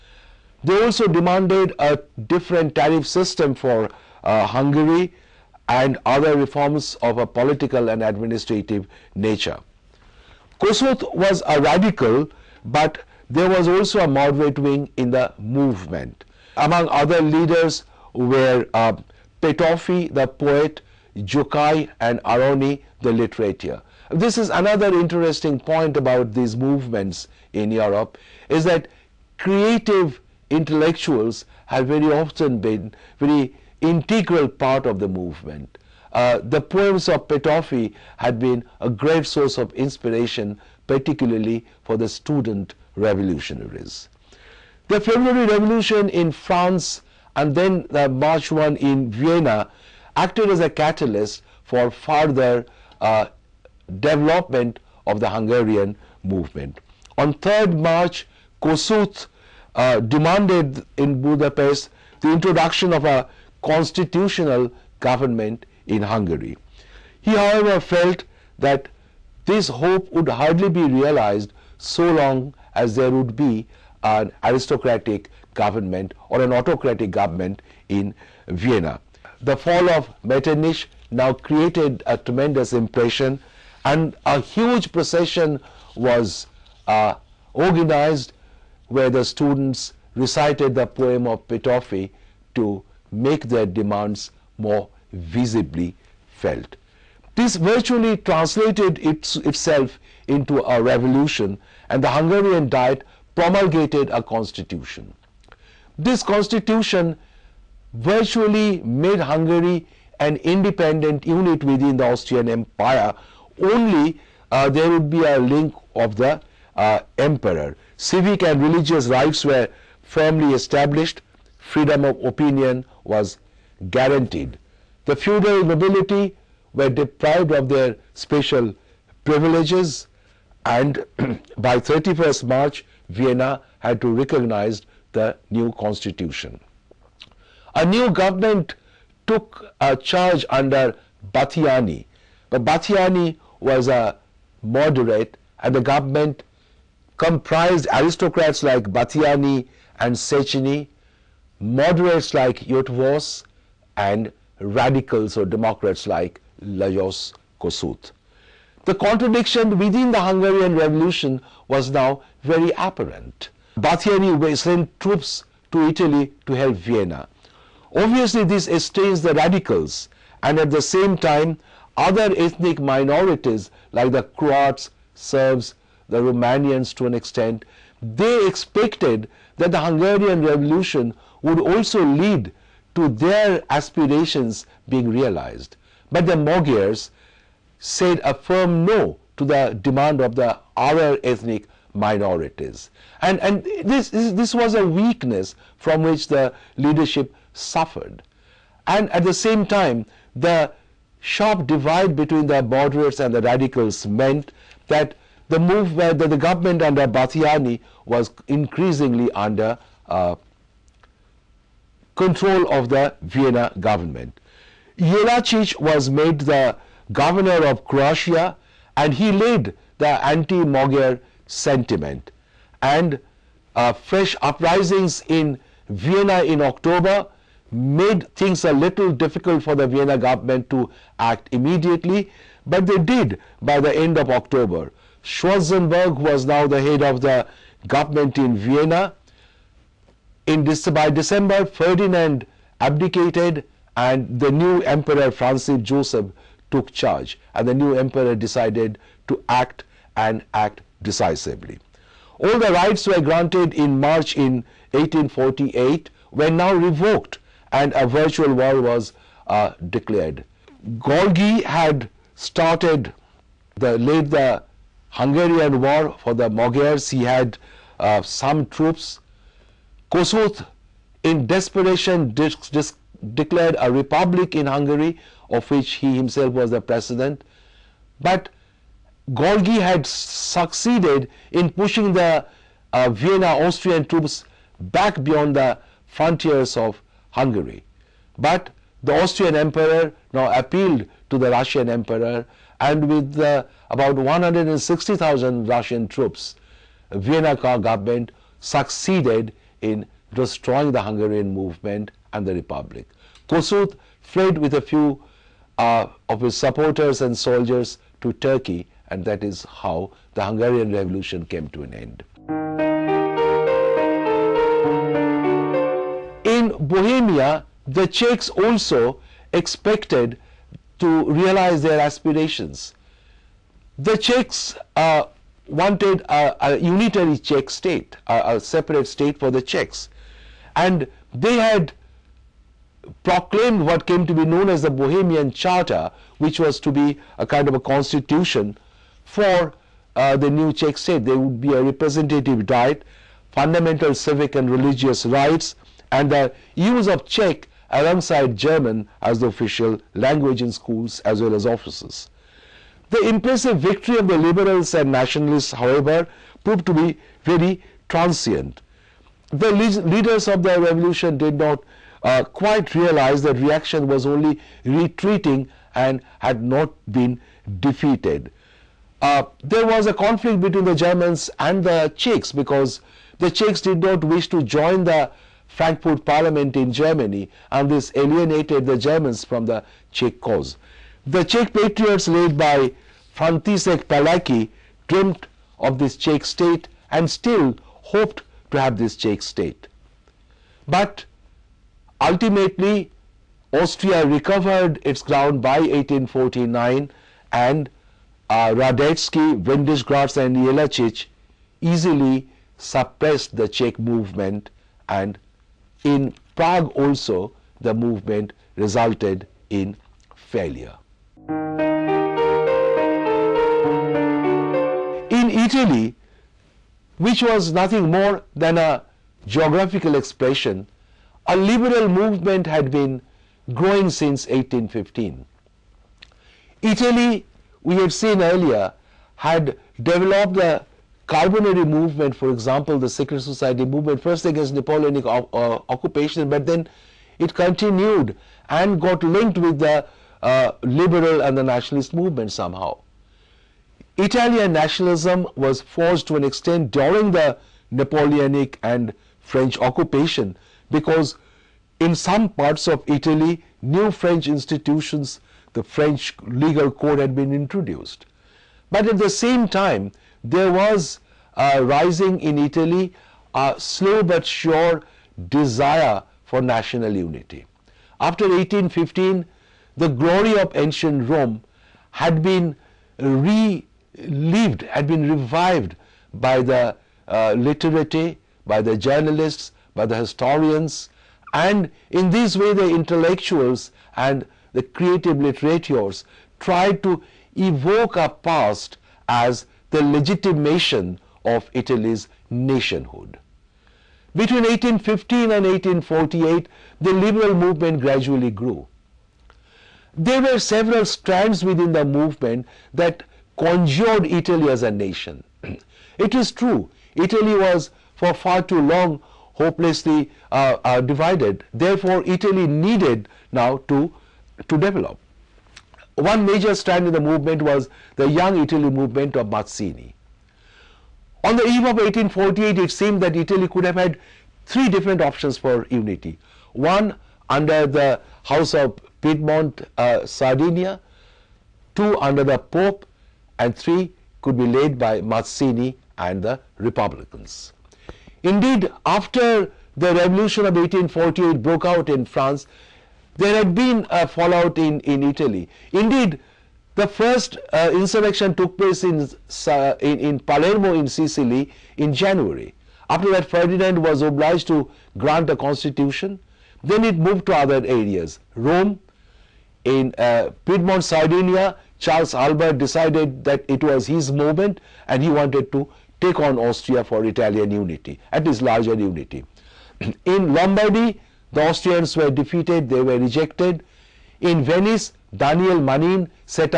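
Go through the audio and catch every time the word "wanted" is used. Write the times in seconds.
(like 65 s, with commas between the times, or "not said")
325 s, 565 s.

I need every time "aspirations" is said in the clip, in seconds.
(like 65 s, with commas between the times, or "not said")
183 s, 322 s.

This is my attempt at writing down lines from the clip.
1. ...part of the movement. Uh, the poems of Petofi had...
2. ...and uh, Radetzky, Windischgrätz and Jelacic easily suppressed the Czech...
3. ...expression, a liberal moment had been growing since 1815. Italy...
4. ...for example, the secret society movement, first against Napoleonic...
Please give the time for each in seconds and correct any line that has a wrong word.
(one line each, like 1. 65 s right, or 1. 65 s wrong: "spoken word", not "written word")
1. 34 s right
2. 397 s right
3. 420 s wrong: "movement", not "moment"
4. 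432 s right.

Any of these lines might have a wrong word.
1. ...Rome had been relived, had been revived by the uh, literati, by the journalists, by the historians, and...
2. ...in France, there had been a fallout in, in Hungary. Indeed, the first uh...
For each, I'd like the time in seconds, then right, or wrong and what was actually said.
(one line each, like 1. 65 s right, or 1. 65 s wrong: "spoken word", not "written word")
1. 471 s right
2. 542 s wrong: "Italy", not "Hungary".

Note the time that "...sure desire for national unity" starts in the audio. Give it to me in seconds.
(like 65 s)
464 s.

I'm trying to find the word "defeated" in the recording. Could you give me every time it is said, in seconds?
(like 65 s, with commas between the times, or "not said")
367 s, 572 s.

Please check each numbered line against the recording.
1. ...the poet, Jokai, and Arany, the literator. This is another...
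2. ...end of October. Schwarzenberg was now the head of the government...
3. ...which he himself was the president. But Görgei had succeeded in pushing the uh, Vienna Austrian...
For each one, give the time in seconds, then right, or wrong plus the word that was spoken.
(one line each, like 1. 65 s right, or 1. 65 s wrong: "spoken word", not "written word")
1. 20 s right
2. 233 s right
3. 275 s right.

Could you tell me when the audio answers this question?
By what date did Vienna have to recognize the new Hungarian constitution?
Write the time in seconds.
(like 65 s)
131 s.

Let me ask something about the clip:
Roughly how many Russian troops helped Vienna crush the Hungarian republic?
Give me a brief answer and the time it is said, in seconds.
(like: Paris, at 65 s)
160,000, at 294 s.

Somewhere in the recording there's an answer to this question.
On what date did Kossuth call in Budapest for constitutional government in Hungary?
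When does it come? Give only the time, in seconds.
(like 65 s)
57 s.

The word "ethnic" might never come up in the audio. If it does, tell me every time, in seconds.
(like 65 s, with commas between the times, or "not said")
172 s, 191 s.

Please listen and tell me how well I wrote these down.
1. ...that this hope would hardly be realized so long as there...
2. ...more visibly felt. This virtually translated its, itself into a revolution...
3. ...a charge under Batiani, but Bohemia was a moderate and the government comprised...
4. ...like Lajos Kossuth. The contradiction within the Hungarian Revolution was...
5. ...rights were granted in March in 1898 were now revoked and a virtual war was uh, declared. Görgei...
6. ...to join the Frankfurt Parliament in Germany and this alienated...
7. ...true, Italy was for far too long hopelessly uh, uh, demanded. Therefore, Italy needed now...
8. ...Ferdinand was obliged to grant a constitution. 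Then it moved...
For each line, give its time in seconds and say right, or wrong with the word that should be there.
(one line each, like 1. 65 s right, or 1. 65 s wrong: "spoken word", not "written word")
1. 68 s right
2. 94 s right
3. 139 s wrong: "Batiani", not "Bohemia"
4. 156 s right
5. 252 s wrong: "1848", not "1898"
6. 374 s right
7. 506 s wrong: "divided", not "demanded"
8. 553 s right.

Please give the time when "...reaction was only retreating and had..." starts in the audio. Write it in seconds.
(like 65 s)
363 s.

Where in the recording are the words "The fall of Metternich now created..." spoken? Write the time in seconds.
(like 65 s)
79 s.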